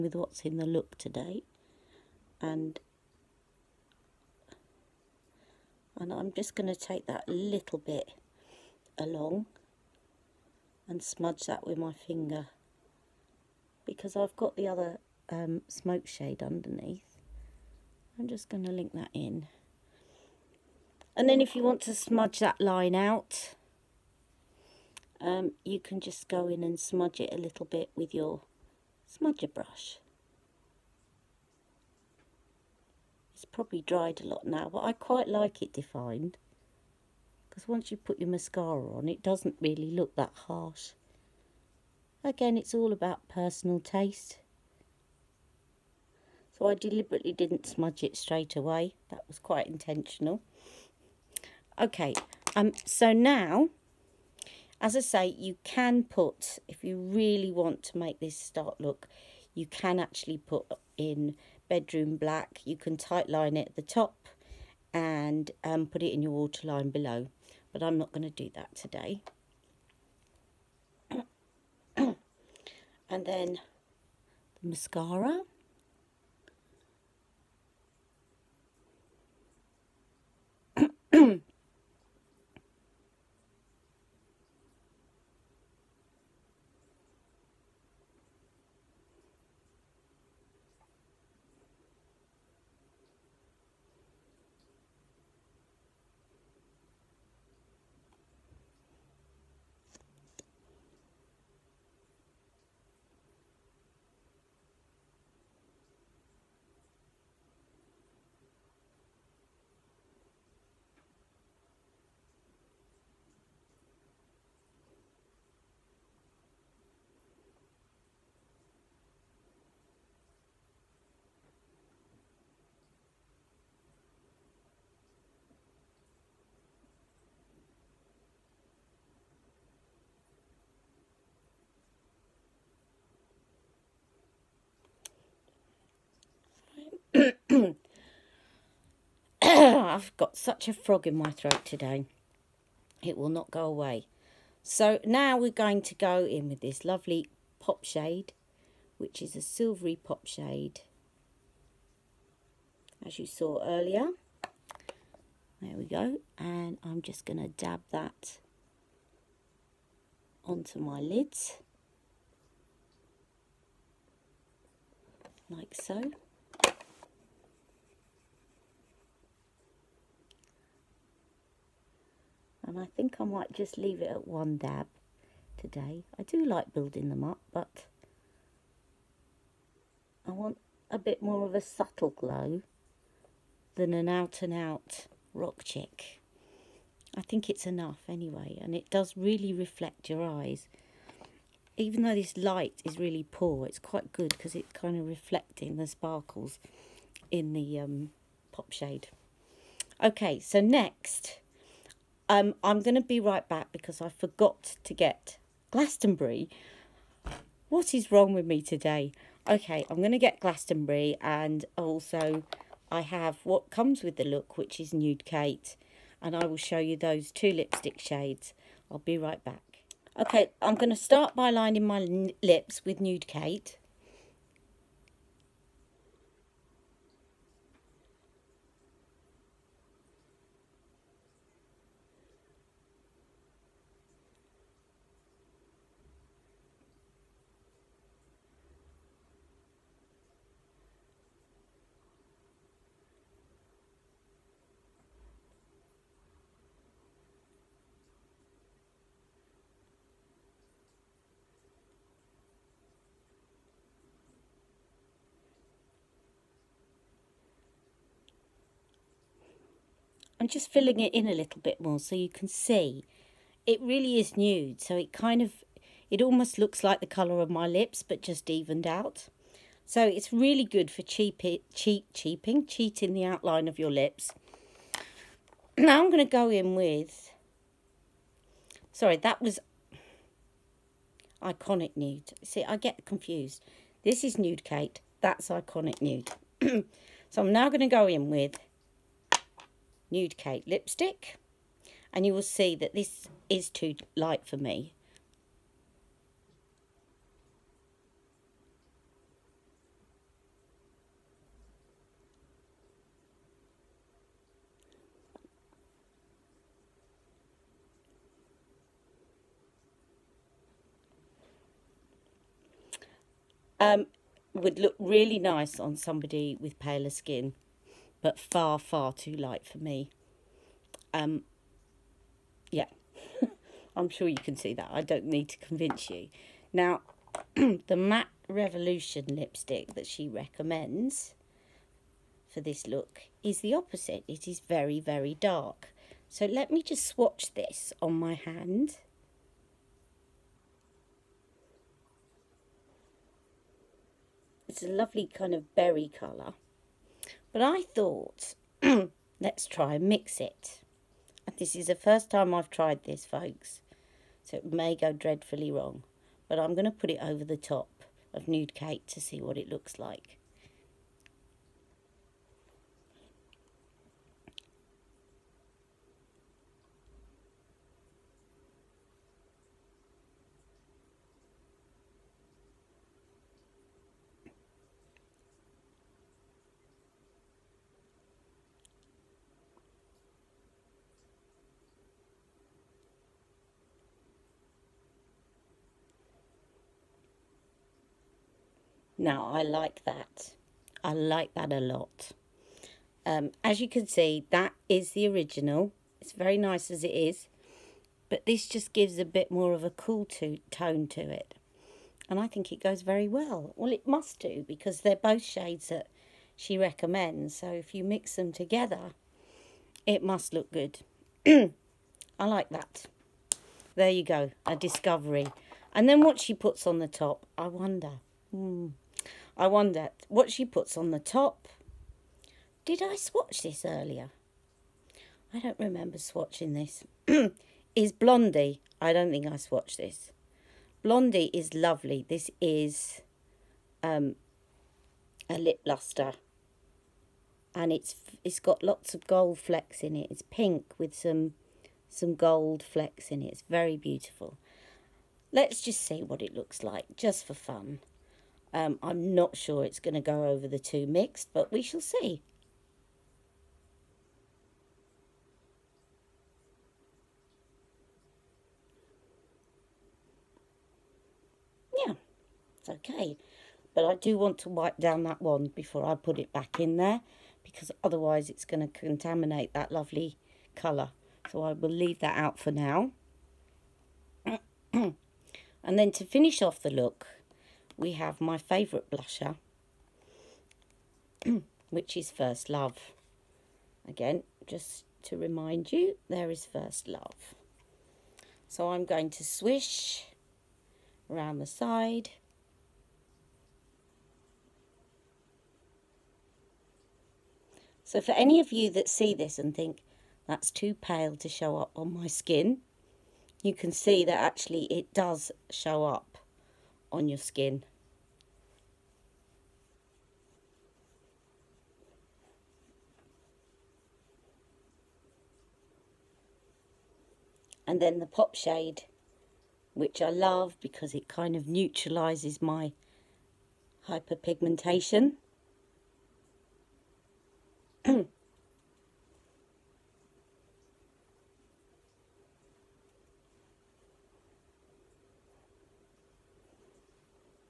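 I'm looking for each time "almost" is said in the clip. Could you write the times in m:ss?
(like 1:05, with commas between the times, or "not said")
4:26.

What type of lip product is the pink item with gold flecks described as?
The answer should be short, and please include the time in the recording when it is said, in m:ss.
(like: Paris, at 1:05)
lip luster, at 7:15.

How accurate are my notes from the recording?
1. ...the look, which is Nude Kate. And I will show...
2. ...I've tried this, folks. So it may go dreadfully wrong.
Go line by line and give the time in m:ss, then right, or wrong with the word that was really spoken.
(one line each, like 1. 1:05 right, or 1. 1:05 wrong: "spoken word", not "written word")
1. 3:34 right
2. 5:52 right.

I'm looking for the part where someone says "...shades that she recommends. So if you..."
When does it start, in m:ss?
6:45.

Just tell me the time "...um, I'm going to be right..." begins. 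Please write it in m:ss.
3:22.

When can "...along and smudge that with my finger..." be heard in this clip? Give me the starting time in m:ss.
0:08.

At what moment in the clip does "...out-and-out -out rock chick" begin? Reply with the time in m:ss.
3:04.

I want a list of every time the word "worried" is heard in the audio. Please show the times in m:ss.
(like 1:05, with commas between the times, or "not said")
not said.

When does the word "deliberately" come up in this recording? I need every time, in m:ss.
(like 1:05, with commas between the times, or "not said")
0:46.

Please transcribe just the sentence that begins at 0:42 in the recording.
Again, it's all about personal taste.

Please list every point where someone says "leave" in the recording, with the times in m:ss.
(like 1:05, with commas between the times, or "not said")
2:53, 7:51.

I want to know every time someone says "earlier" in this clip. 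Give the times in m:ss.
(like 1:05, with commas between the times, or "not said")
2:33, 7:03.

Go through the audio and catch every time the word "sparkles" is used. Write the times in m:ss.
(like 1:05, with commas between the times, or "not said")
3:15.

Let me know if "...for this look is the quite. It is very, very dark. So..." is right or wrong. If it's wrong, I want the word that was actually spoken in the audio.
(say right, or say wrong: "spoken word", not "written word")
wrong: "opposite", not "quite".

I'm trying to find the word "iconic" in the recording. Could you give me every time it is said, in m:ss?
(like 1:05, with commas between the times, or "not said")
4:41, 4:45.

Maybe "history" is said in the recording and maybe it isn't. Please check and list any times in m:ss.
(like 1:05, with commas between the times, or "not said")
not said.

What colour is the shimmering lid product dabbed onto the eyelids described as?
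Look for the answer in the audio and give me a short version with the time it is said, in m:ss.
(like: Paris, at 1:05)
silvery, at 2:29.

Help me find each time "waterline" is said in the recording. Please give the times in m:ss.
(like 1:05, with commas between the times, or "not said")
1:06.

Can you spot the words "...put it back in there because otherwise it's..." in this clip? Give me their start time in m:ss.
7:46.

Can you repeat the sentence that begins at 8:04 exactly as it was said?
Again, just to remind you, there is First Love.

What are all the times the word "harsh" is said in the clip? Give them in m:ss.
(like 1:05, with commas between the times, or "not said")
0:40.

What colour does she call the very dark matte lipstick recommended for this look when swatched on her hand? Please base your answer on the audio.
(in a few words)
berry.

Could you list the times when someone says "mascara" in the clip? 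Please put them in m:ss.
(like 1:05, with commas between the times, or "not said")
0:38, 1:14.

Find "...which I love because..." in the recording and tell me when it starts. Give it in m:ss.
8:39.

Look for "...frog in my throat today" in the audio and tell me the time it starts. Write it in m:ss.
2:20.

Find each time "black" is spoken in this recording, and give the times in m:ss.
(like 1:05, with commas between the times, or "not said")
1:02.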